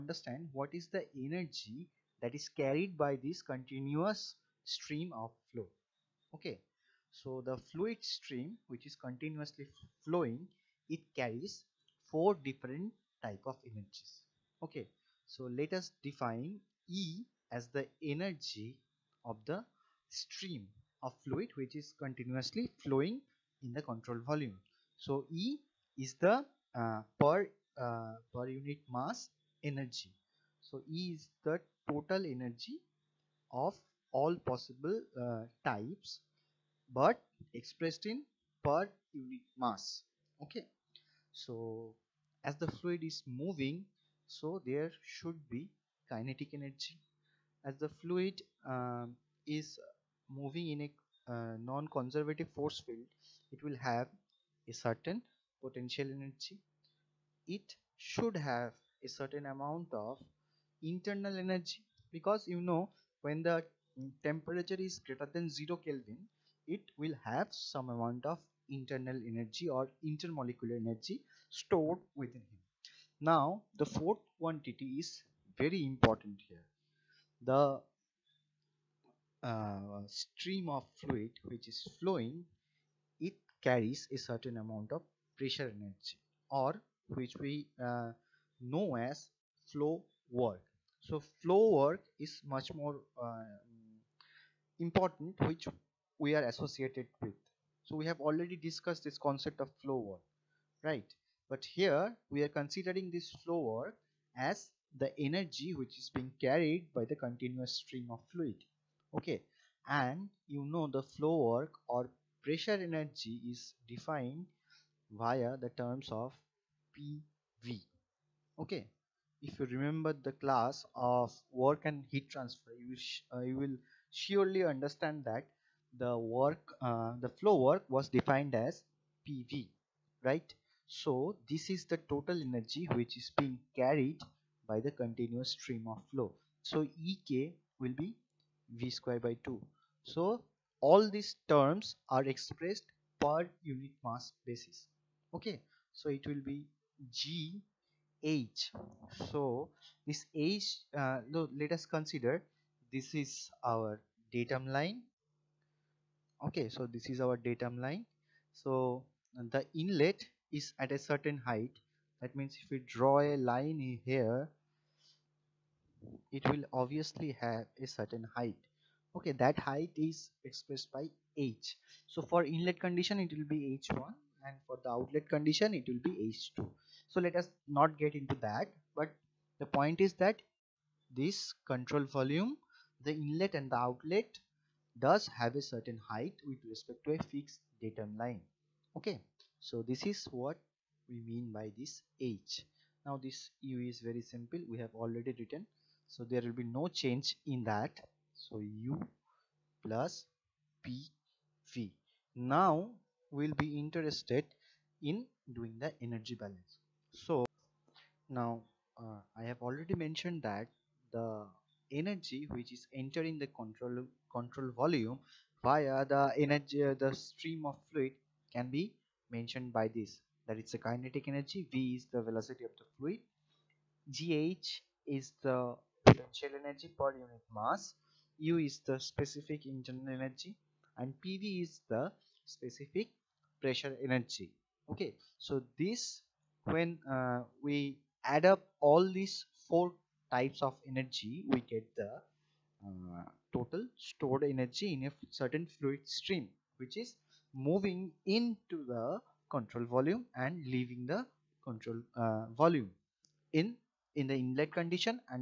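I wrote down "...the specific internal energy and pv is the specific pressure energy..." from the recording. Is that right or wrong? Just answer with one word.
right.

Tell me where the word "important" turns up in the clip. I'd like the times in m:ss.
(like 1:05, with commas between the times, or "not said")
1:15, 1:34.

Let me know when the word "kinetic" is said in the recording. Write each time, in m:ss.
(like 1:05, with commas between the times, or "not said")
0:46, 3:40.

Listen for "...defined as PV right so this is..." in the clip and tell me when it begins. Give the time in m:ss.
2:08.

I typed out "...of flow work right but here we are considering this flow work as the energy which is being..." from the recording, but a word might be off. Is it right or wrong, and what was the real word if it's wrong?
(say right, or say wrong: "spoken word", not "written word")
right.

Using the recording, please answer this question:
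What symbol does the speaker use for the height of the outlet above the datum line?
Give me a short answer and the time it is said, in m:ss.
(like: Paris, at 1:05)
H2, at 2:56.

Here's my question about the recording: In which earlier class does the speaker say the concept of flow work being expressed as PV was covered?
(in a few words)
Work and heat transfer.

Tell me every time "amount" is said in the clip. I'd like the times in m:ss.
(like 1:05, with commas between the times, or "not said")
0:59, 1:07, 1:24.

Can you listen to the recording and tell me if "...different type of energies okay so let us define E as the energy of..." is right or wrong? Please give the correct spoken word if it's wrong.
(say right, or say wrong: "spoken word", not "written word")
right.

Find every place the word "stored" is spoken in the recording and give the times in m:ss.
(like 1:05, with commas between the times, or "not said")
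1:11, 4:04.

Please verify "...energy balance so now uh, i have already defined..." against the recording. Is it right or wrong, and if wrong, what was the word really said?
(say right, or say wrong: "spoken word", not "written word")
wrong: "mentioned", not "defined".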